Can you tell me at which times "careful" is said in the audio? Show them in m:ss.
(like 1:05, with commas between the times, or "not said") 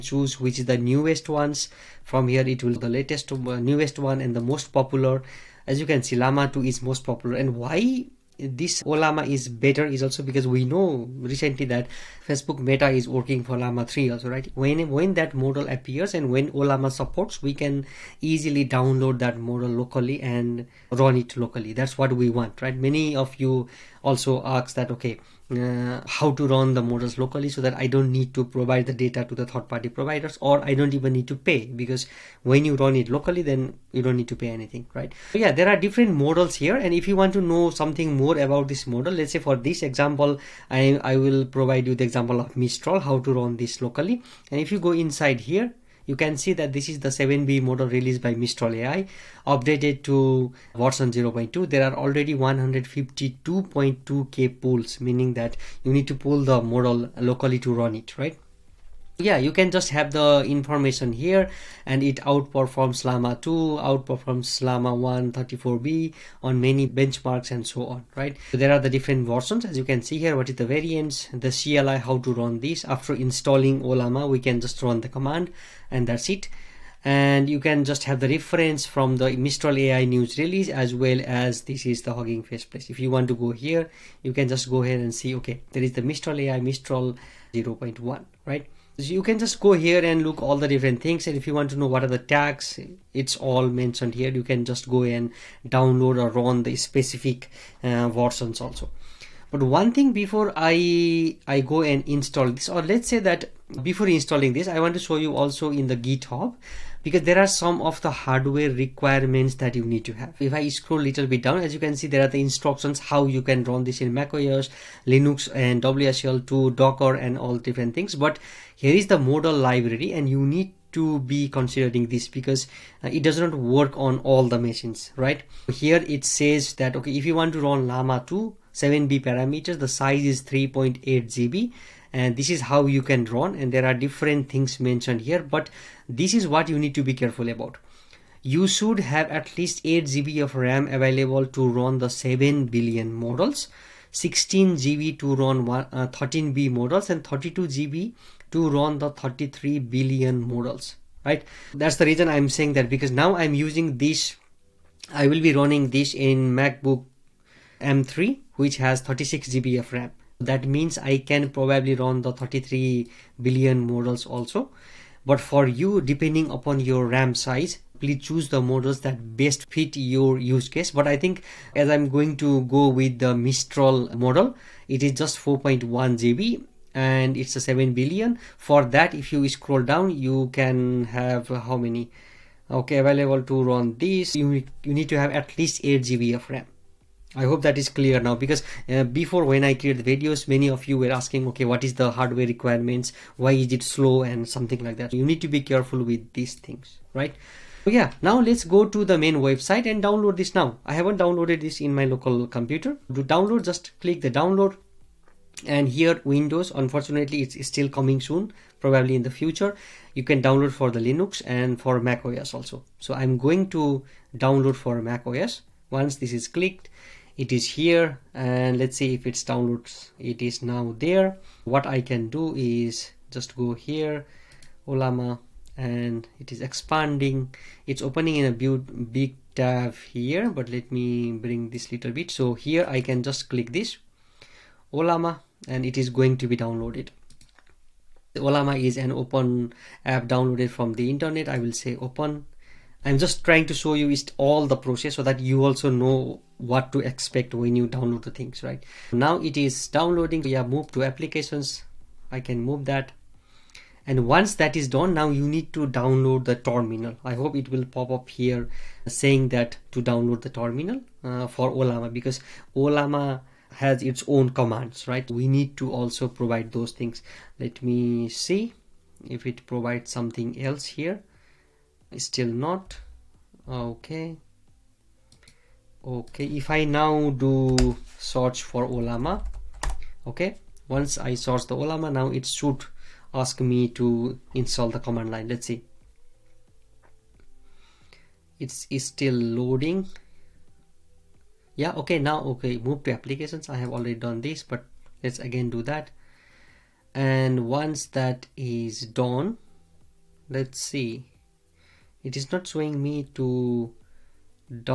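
2:17, 3:15.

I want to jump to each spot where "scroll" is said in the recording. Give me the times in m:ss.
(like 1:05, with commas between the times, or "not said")
1:50, 2:59.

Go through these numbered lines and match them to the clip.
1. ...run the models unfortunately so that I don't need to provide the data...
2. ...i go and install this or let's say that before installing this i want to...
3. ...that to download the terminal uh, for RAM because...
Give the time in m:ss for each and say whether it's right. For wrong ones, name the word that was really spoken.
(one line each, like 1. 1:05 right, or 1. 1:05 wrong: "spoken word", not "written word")
1. 0:26 wrong: "locally", not "unfortunately"
2. 1:41 right
3. 4:19 wrong: "Ollama", not "RAM".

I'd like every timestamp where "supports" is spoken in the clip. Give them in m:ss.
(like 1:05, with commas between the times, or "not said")
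0:16.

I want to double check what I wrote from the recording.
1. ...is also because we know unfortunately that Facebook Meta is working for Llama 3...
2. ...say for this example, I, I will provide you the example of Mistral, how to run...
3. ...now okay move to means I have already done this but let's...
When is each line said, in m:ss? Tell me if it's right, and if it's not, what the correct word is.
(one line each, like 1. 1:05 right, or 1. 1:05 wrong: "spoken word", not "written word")
1. 0:09 wrong: "recently", not "unfortunately"
2. 0:39 right
3. 4:52 wrong: "applications", not "means".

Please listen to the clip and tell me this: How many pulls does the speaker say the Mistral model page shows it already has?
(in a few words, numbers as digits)
152.2k.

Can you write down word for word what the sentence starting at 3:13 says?
Why is it slow and something like that?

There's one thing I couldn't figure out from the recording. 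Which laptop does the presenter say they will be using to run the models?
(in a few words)
MacBook M3.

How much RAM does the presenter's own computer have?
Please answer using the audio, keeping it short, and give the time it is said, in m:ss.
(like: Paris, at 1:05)
36 GB, at 2:39.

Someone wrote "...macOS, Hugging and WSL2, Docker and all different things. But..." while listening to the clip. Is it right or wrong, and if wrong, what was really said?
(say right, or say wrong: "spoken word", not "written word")
wrong: "Linux", not "Hugging".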